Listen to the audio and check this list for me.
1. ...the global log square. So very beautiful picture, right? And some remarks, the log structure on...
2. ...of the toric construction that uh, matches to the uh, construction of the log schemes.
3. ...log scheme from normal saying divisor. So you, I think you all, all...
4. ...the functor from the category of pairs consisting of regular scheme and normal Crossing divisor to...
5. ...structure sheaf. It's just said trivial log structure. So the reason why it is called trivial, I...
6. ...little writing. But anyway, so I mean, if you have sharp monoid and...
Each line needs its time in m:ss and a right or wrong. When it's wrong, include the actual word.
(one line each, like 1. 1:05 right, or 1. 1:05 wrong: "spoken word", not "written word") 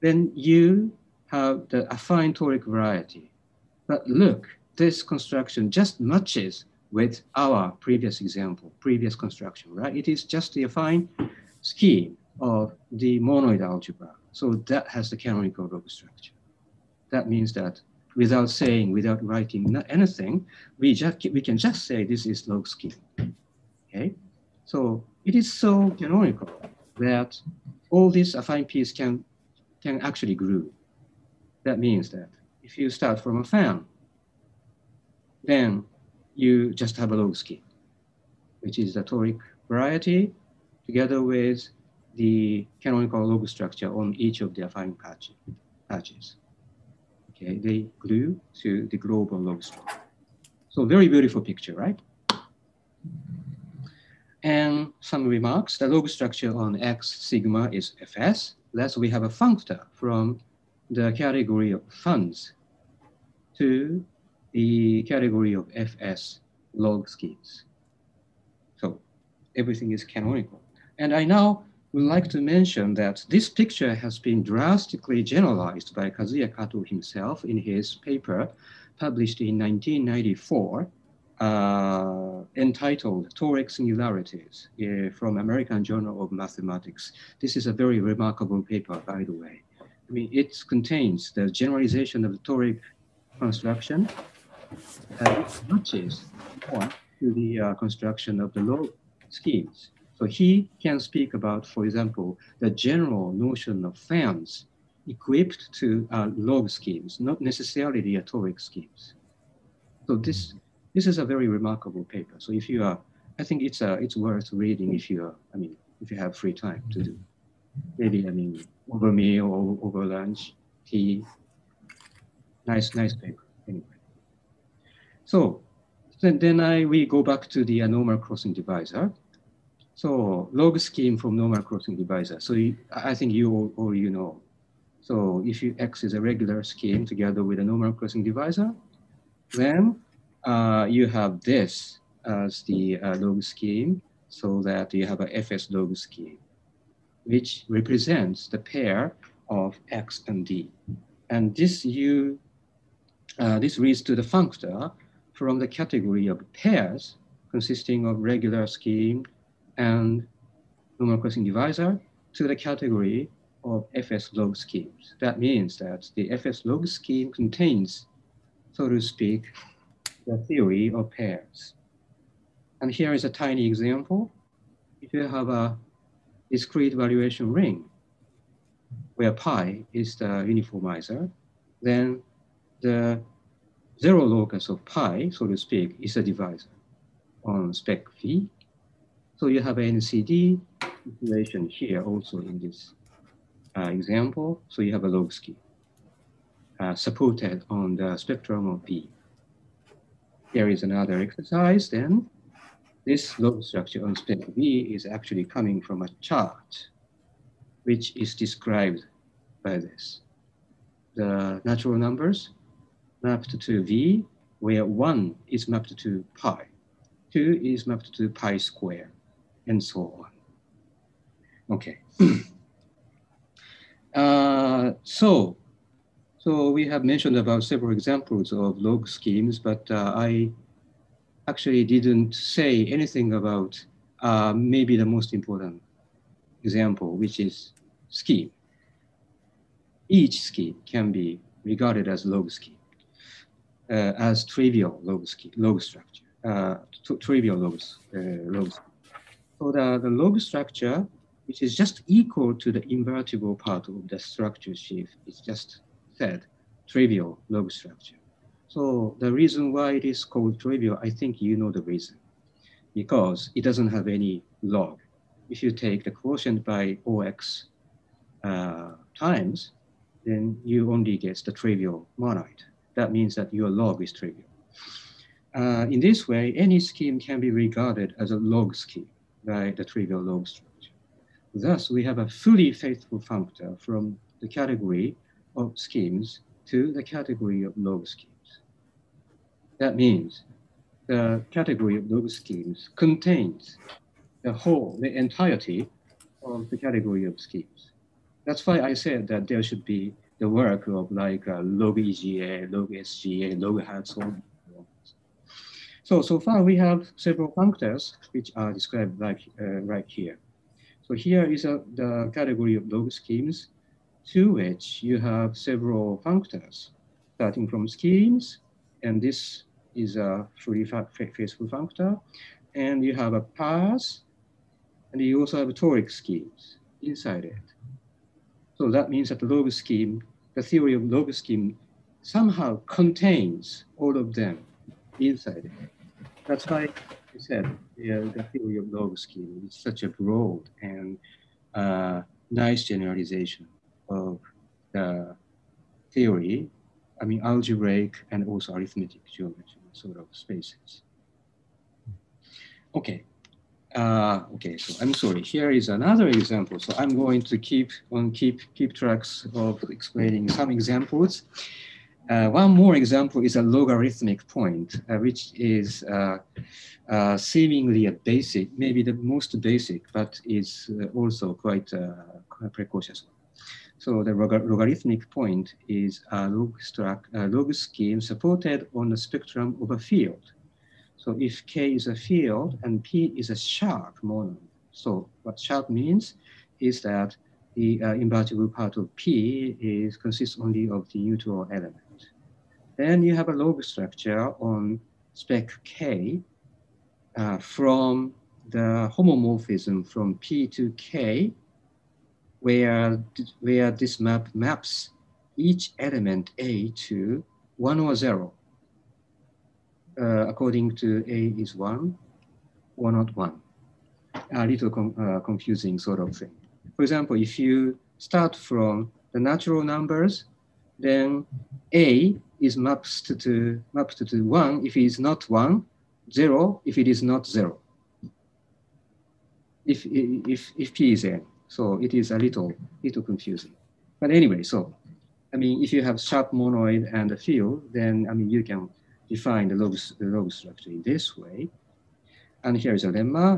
1. 0:48 wrong: "structure", not "square"
2. 1:32 right
3. 2:10 wrong: "crossing", not "saying"
4. 2:34 right
5. 4:14 right
6. 7:13 wrong: "confusing", not "writing".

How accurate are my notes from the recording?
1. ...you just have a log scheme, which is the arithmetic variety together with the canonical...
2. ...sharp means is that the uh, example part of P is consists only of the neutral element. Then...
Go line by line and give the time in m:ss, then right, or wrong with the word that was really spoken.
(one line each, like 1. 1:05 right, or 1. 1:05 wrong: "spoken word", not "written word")
1. 0:36 wrong: "toric", not "arithmetic"
2. 6:25 wrong: "invertible", not "example".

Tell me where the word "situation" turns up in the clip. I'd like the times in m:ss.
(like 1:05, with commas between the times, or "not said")
3:11.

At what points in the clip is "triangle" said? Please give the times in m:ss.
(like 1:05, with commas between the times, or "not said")
not said.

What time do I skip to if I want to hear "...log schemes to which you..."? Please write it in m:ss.
5:12.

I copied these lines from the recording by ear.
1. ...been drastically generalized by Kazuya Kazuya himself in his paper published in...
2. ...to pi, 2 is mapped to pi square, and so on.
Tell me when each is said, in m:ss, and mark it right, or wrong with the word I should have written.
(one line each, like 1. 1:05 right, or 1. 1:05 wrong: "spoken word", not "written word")
1. 1:14 wrong: "Kato", not "Kazuya"
2. 3:35 right.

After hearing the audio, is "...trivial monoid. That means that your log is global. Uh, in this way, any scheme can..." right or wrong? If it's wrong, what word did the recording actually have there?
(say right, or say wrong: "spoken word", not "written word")
wrong: "trivial", not "global".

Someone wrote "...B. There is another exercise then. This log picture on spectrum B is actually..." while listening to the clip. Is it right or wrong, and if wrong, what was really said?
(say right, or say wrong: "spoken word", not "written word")
wrong: "structure", not "picture".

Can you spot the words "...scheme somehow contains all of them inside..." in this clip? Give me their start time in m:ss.
5:31.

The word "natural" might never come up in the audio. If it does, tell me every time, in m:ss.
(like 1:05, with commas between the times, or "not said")
3:31, 6:59.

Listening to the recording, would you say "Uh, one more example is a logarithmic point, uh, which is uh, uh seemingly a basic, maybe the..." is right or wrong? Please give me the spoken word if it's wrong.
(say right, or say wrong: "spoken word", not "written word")
right.